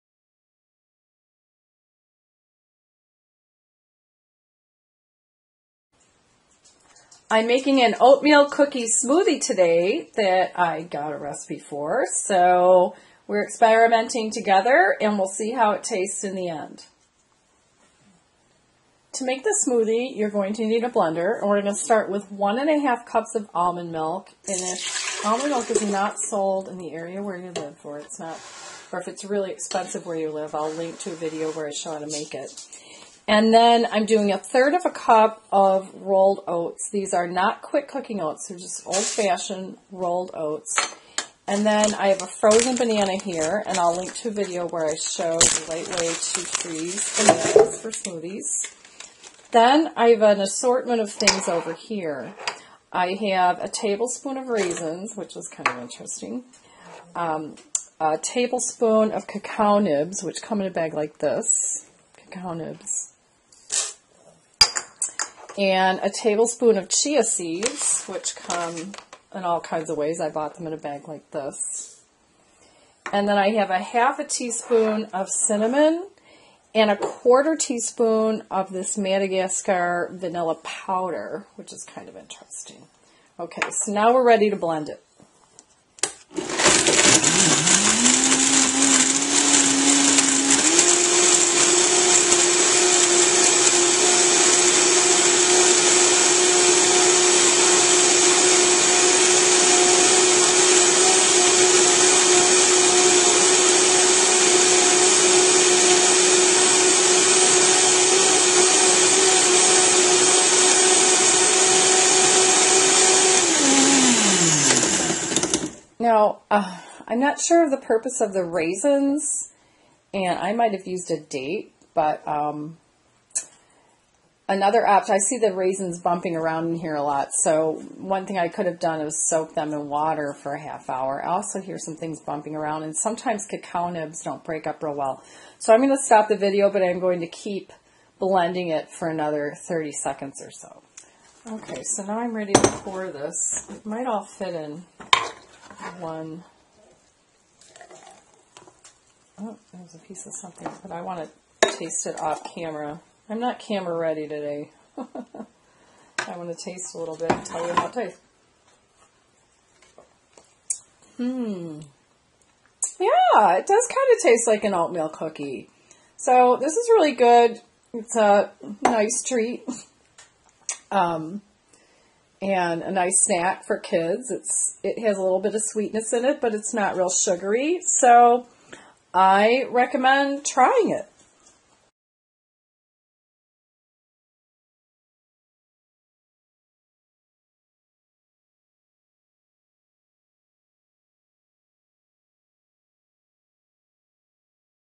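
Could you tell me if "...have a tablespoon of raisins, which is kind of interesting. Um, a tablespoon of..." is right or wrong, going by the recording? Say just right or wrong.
right.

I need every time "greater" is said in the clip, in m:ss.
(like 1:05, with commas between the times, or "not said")
not said.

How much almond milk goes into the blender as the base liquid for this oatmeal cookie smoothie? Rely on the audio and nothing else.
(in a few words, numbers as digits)
1.5 cups.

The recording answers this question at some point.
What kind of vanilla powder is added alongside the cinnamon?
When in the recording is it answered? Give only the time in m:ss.
1:18.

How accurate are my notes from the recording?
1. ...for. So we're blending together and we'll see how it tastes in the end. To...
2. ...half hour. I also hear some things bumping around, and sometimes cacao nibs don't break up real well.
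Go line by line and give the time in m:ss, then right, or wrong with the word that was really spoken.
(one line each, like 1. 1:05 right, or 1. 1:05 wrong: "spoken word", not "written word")
1. 0:11 wrong: "experimenting", not "blending"
2. 2:10 right.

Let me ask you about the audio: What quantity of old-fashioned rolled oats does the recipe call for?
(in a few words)
1/3 cup.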